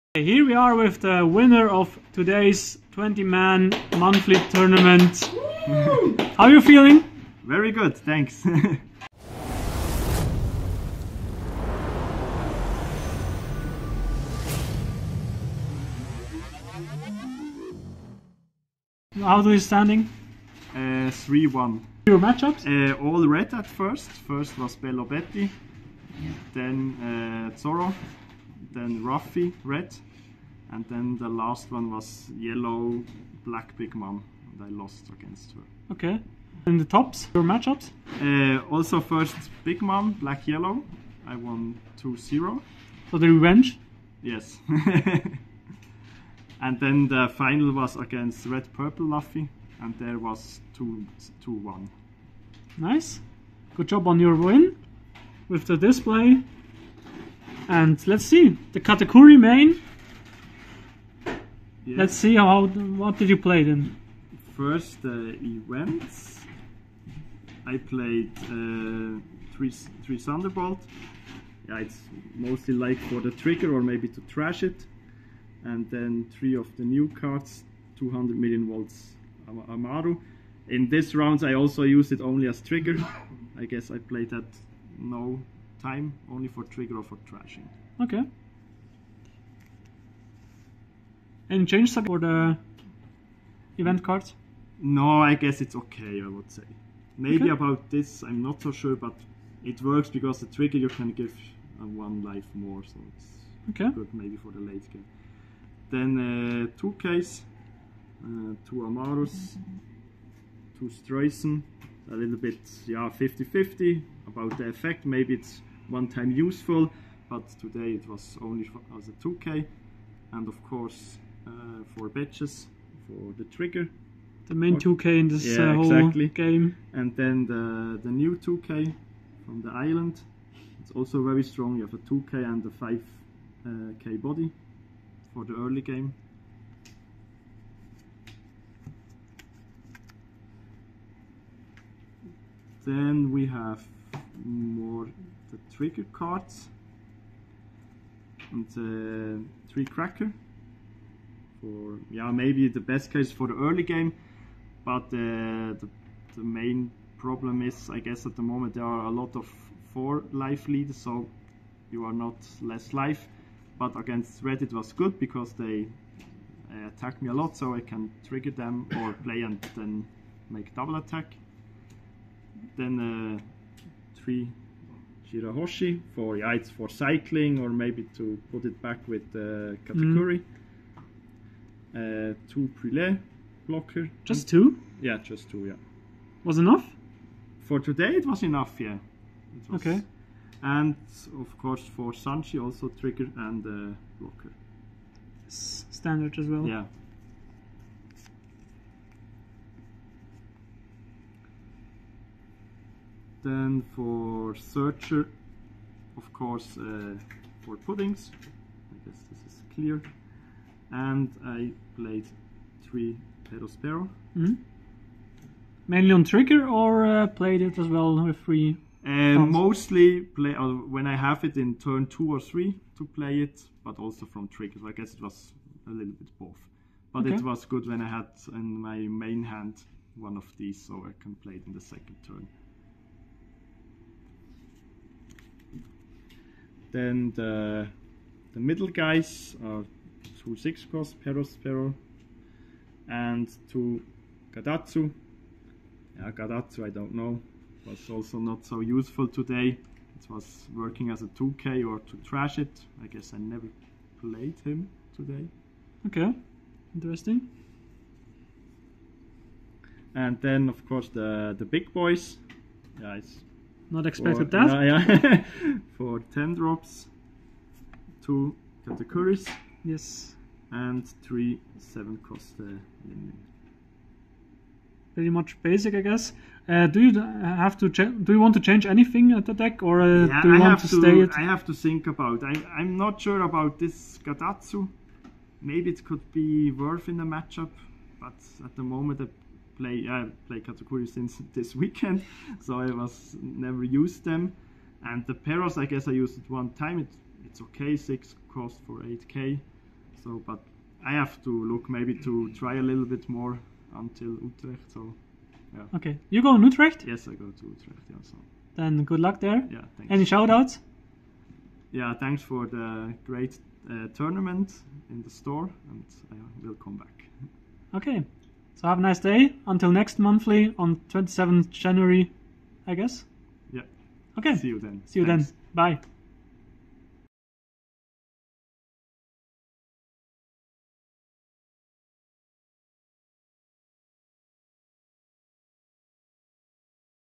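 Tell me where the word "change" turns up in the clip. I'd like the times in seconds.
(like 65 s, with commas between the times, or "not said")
91 s, 278 s.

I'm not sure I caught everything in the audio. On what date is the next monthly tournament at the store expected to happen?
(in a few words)
27 January.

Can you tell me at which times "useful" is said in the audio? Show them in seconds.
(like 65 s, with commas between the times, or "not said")
116 s, 248 s.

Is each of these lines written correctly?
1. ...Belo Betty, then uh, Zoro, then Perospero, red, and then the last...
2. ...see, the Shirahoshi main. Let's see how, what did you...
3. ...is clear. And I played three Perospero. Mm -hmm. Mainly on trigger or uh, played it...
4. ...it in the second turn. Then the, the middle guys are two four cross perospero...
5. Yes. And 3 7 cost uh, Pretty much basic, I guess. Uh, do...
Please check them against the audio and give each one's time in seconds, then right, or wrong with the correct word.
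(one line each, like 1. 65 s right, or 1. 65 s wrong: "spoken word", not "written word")
1. 24 s wrong: "Ruffy", not "Perospero"
2. 58 s wrong: "Katakuri", not "Shirahoshi"
3. 209 s right
4. 231 s wrong: "six", not "four"
5. 269 s right.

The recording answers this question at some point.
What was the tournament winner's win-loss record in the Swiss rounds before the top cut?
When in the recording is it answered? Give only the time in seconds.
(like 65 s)
20 s.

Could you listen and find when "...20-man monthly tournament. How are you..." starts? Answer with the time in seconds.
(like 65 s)
2 s.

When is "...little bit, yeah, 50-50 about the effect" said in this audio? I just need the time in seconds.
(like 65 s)
112 s.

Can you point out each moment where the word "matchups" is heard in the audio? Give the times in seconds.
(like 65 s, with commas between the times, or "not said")
22 s, 37 s, 287 s.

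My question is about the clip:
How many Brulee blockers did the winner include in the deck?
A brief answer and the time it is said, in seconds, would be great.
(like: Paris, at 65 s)
2, at 182 s.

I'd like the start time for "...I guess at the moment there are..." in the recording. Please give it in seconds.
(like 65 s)
157 s.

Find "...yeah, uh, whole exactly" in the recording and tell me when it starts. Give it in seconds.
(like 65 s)
125 s.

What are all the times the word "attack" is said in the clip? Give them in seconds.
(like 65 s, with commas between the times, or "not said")
166 s, 170 s.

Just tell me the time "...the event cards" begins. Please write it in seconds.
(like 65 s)
92 s.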